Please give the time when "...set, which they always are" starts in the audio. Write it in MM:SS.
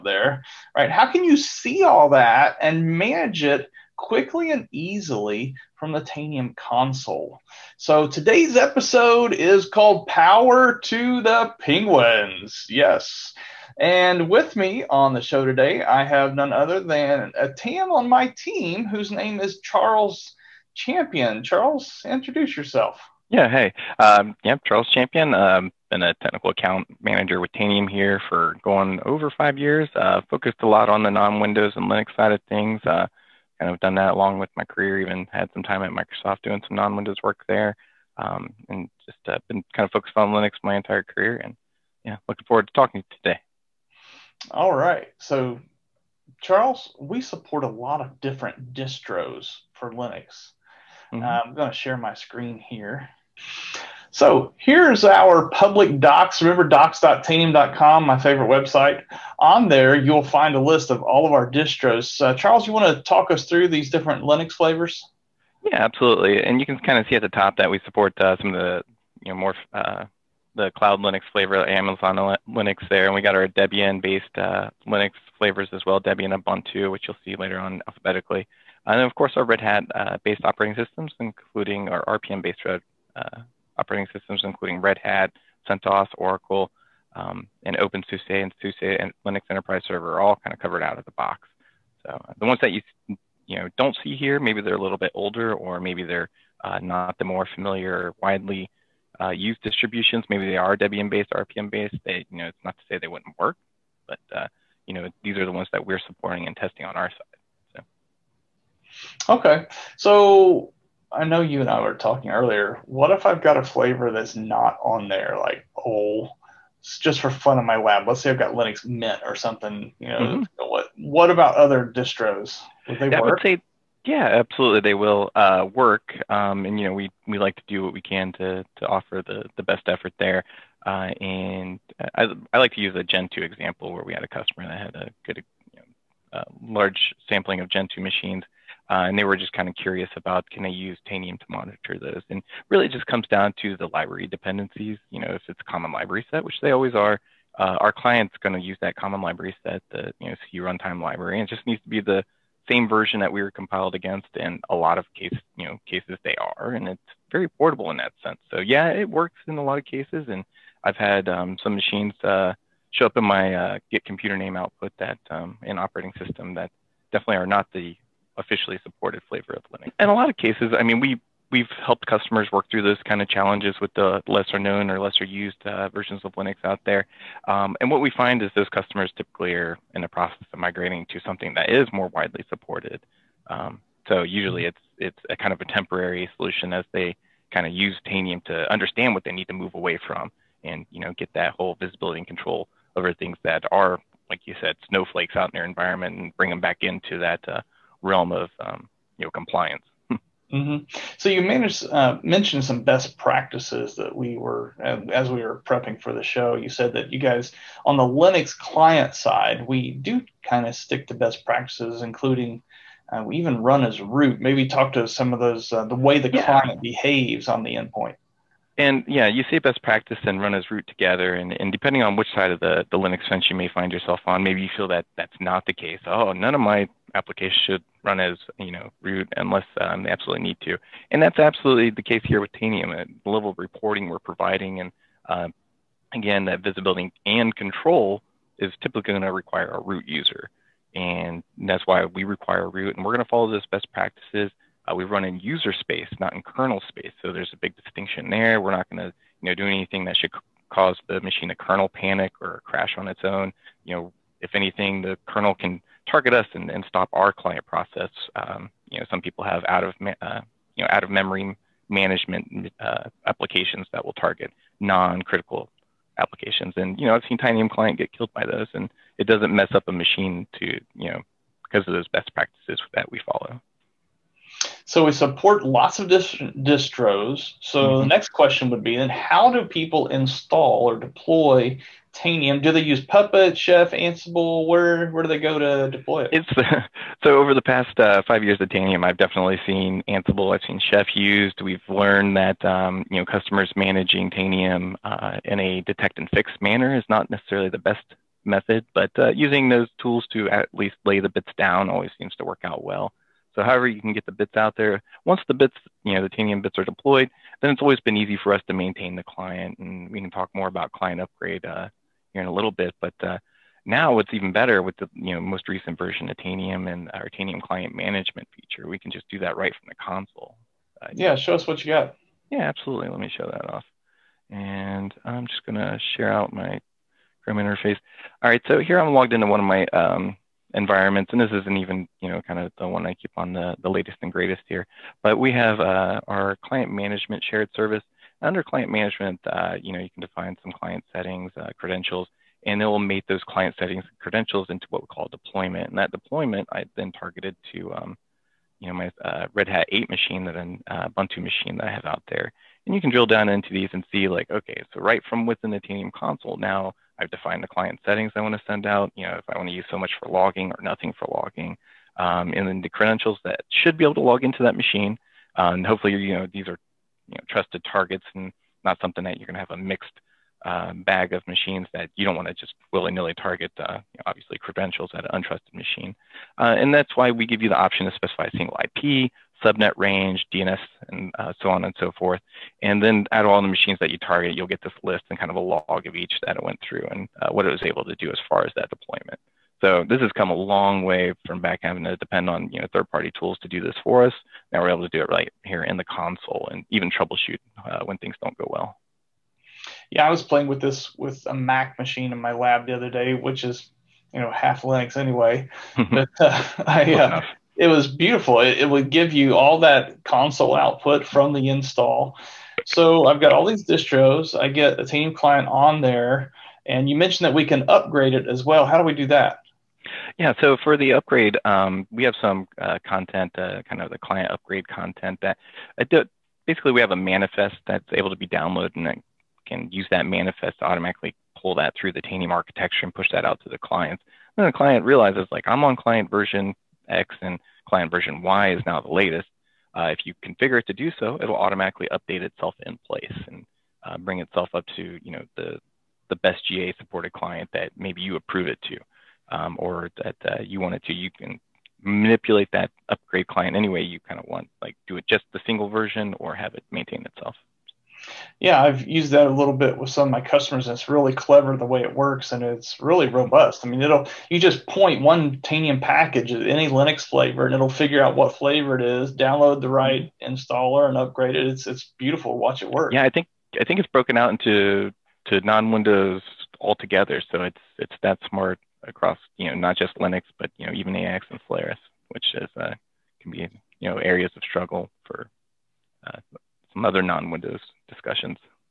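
02:26.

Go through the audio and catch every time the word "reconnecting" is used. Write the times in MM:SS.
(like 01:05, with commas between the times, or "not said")
not said.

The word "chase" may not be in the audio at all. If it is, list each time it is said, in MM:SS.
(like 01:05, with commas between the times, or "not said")
not said.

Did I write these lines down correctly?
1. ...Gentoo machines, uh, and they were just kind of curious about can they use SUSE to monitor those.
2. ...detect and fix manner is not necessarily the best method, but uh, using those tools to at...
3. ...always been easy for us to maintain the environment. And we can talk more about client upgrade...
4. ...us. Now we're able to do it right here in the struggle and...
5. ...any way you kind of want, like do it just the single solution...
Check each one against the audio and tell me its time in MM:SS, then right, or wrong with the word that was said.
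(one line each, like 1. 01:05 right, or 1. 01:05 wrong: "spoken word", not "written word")
1. 02:17 wrong: "Tanium", not "SUSE"
2. 04:55 right
3. 05:07 wrong: "client", not "environment"
4. 06:34 wrong: "console", not "struggle"
5. 07:33 wrong: "version", not "solution".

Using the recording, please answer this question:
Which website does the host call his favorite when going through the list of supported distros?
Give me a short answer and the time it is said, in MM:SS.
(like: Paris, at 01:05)
docs.tanium.com, at 00:56.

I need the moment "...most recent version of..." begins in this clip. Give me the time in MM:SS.
05:15.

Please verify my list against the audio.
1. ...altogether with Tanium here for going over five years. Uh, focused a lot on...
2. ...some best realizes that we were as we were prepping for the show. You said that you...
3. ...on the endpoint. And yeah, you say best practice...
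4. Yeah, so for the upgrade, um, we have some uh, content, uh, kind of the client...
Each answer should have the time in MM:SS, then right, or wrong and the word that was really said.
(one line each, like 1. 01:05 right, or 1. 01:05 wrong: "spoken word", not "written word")
1. 00:27 wrong: "manager", not "altogether"
2. 03:22 wrong: "practices", not "realizes"
3. 03:37 right
4. 07:00 right.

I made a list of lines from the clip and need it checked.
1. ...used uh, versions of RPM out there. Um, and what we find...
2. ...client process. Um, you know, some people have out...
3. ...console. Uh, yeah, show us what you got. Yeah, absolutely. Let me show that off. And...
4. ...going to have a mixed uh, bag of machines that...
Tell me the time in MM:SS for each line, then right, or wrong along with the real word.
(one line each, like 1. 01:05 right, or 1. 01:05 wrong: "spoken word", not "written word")
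1. 02:55 wrong: "Linux", not "RPM"
2. 04:17 right
3. 05:19 right
4. 06:09 right.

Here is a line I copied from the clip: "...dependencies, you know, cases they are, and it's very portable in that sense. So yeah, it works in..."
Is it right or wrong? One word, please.
wrong.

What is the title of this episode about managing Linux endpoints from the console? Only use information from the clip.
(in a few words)
Power to the Penguins.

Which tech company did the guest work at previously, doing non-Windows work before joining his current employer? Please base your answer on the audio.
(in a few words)
Microsoft.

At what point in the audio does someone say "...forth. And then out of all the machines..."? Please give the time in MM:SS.
06:22.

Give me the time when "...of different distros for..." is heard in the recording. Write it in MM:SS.
00:47.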